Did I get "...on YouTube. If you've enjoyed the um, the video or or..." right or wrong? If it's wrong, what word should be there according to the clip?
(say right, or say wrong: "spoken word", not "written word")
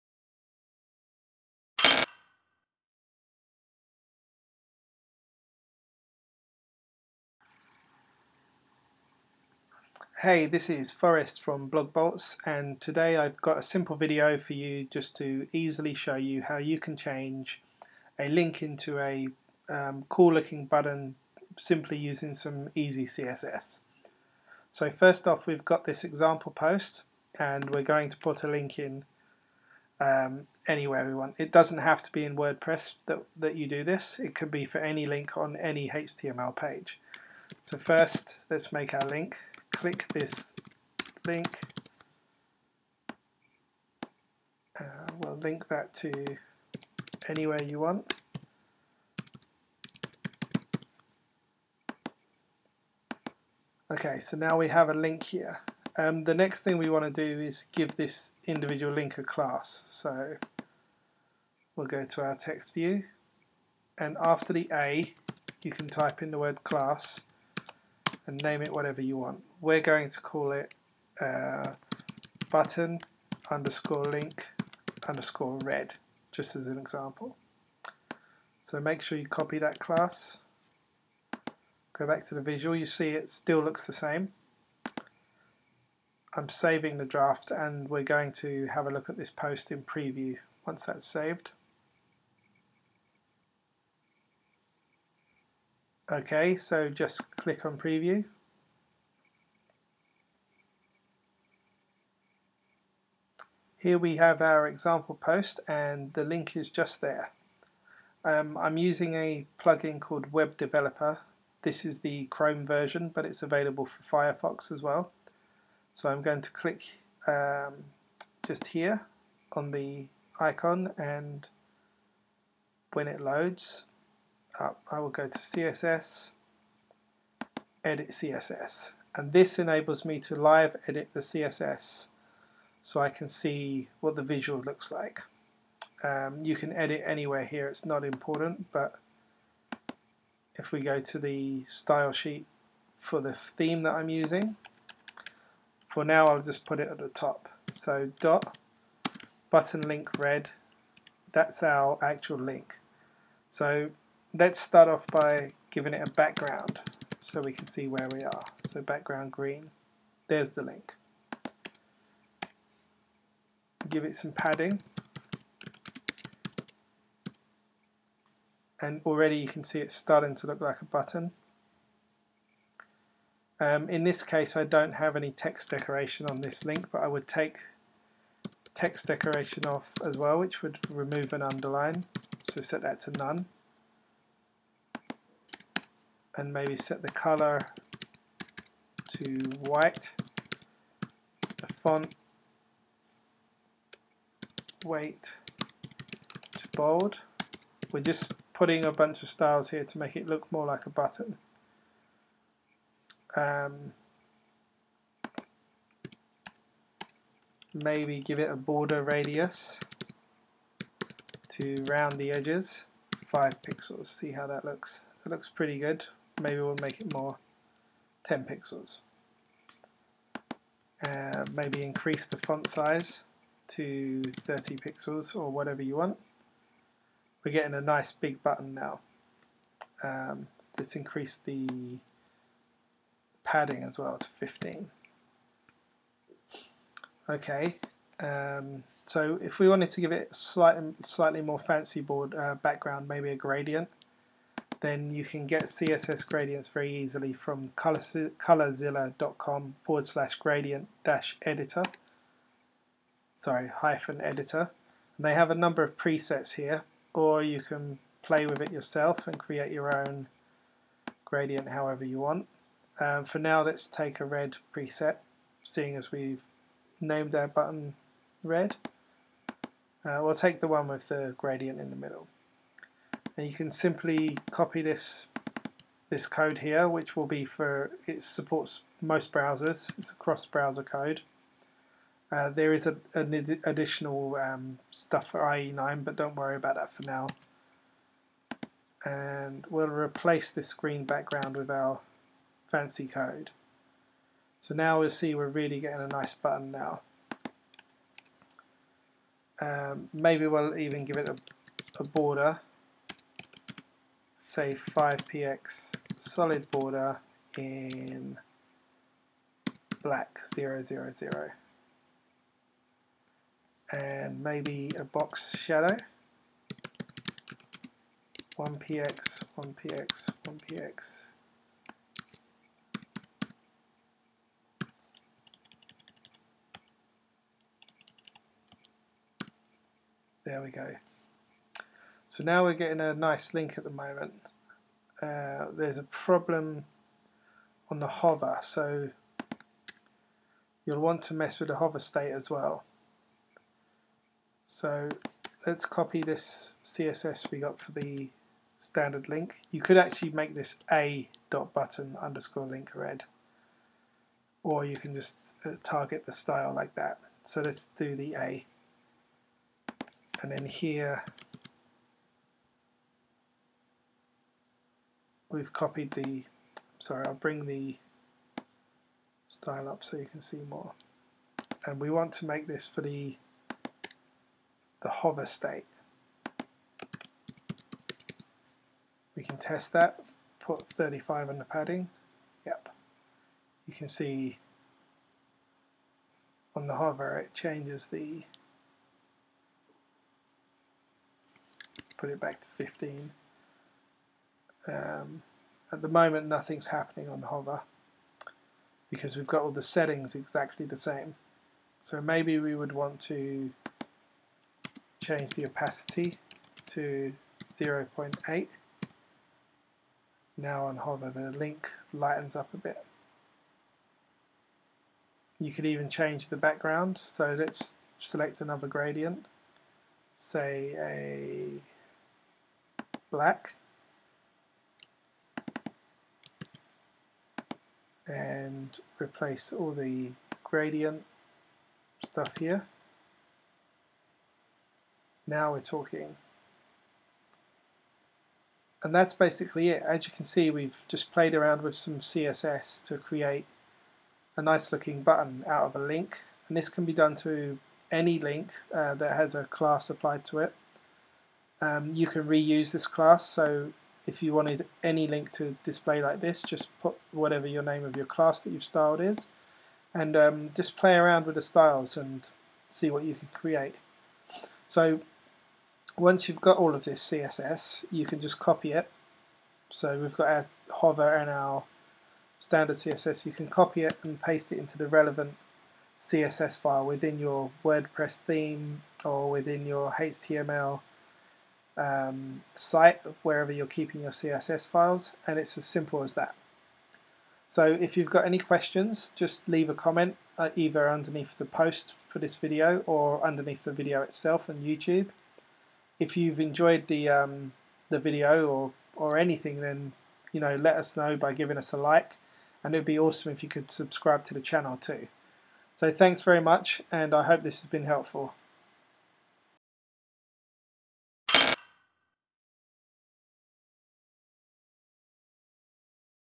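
right.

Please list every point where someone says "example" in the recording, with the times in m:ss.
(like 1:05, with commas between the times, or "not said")
0:26, 1:16, 1:44.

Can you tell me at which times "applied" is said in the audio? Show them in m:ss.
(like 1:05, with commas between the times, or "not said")
7:30.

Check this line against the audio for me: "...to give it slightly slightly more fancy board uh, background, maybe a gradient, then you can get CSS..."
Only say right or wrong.
right.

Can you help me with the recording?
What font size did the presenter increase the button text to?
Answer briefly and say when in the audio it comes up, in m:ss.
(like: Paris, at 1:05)
30 pixels, at 3:44.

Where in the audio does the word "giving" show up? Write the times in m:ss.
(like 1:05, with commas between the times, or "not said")
2:35, 8:21.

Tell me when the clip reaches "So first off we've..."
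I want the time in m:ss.
0:24.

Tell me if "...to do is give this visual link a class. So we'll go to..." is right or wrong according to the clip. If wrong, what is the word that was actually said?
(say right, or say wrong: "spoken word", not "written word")
wrong: "individual", not "visual".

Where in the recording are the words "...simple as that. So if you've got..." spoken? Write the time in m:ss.
8:05.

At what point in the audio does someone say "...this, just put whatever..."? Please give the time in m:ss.
7:36.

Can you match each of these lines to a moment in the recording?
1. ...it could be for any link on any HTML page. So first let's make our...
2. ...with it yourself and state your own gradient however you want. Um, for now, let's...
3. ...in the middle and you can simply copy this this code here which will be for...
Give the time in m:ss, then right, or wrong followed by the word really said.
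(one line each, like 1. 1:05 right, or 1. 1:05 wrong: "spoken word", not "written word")
1. 0:34 right
2. 4:18 wrong: "create", not "state"
3. 4:31 right.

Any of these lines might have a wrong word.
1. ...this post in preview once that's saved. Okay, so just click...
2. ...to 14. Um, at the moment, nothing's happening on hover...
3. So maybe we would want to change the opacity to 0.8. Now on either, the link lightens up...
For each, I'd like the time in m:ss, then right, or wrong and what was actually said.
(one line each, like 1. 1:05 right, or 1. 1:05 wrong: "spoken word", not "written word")
1. 1:29 right
2. 6:32 wrong: "15", not "14"
3. 6:42 wrong: "hover", not "either".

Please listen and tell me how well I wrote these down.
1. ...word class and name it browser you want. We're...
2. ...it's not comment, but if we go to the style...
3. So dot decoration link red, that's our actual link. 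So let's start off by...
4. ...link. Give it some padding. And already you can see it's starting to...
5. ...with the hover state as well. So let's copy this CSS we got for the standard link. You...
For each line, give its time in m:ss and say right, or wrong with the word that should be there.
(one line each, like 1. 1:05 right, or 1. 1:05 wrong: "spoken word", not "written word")
1. 1:06 wrong: "whatever", not "browser"
2. 2:17 wrong: "important", not "comment"
3. 2:27 wrong: "button", not "decoration"
4. 2:40 right
5. 5:41 right.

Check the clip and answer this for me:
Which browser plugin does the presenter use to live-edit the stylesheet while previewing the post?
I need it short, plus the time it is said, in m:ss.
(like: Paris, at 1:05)
Web Developer, at 1:50.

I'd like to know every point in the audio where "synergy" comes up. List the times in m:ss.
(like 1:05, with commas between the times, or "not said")
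not said.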